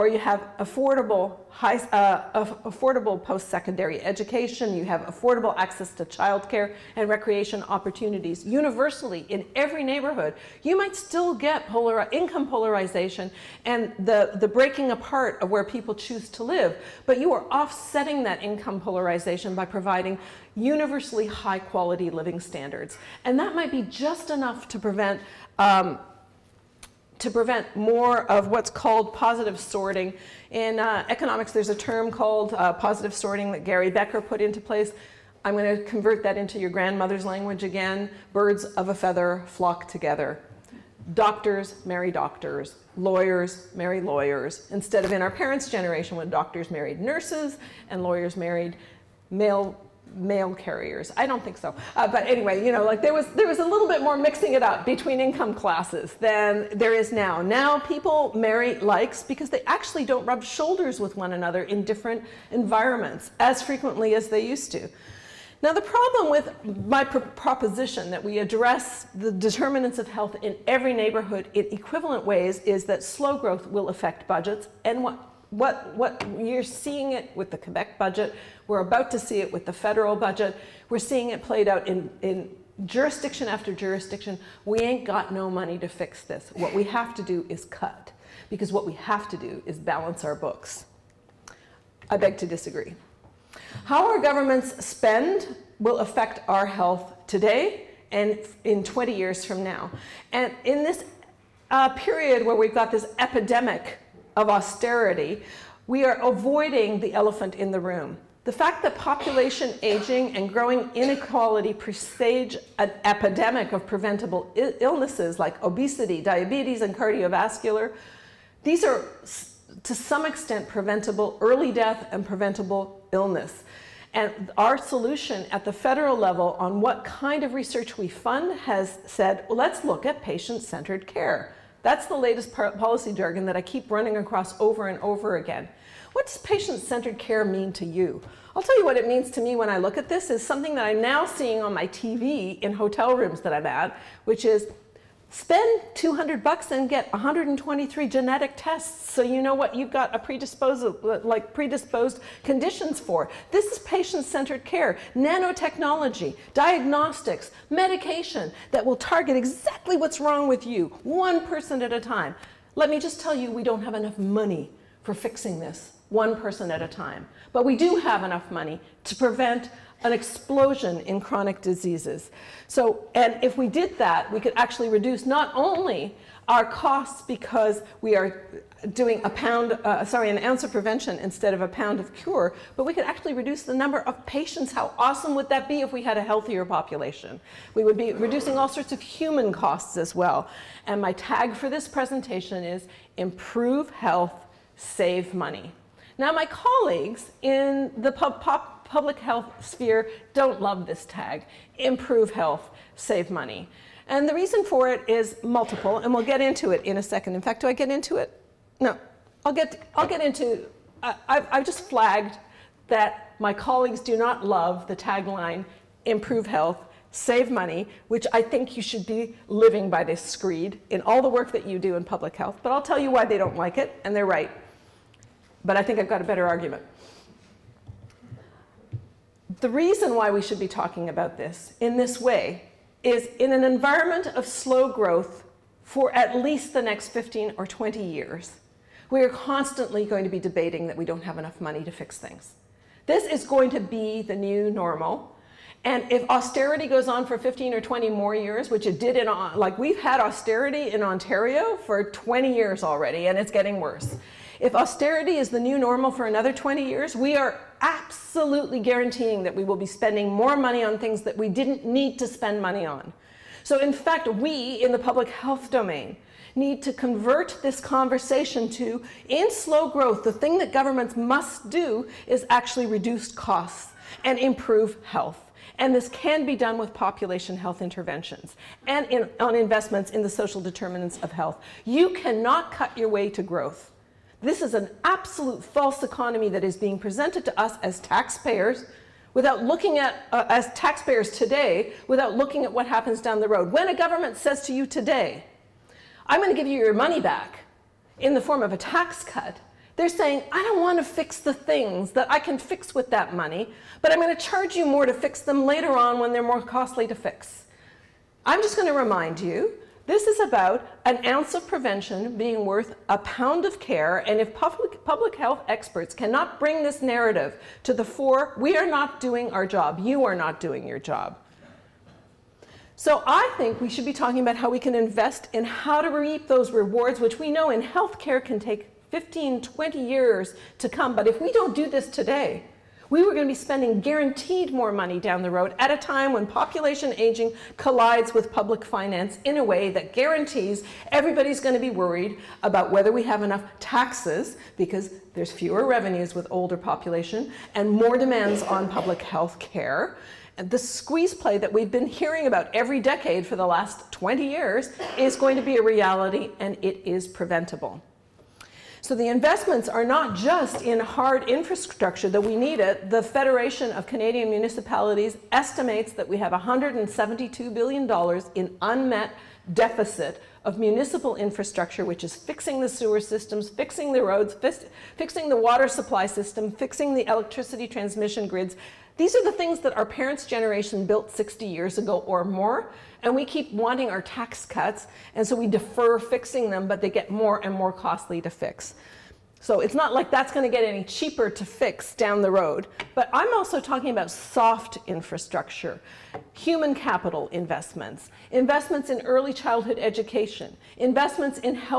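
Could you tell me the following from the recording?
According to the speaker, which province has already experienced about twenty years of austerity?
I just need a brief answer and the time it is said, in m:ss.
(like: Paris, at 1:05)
Ontario, at 4:11.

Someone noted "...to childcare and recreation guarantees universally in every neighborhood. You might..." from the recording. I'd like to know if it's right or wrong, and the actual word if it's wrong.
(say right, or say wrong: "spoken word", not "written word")
wrong: "opportunities", not "guarantees".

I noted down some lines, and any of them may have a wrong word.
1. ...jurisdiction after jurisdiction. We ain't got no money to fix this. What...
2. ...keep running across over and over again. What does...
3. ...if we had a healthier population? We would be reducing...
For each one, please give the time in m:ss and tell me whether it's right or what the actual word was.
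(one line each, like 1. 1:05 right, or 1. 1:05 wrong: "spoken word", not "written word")
1. 1:22 right
2. 2:13 right
3. 3:05 right.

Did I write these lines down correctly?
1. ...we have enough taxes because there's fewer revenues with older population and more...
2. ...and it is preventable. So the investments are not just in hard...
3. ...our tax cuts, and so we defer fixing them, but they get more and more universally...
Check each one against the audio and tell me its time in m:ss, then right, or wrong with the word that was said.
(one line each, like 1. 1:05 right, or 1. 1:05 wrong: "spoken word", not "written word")
1. 5:43 right
2. 5:56 right
3. 6:24 wrong: "costly", not "universally".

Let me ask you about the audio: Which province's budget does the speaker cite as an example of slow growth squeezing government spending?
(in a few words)
Quebec.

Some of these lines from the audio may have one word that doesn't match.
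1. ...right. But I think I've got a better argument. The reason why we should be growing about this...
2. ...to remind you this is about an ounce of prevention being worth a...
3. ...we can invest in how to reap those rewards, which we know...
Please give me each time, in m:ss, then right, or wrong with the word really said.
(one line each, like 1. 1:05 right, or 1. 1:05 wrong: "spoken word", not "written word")
1. 3:44 wrong: "talking", not "growing"
2. 5:08 right
3. 5:24 right.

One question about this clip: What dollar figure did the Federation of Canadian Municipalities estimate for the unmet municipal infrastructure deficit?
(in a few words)
$172 billion.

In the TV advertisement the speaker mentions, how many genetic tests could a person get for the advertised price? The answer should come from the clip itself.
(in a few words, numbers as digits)
123.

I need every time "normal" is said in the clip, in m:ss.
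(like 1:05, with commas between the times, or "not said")
4:04, 4:15.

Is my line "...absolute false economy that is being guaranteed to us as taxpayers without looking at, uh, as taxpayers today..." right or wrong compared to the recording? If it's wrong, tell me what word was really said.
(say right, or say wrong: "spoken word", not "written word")
wrong: "presented", not "guaranteed".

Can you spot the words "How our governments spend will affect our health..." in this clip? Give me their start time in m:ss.
1:33.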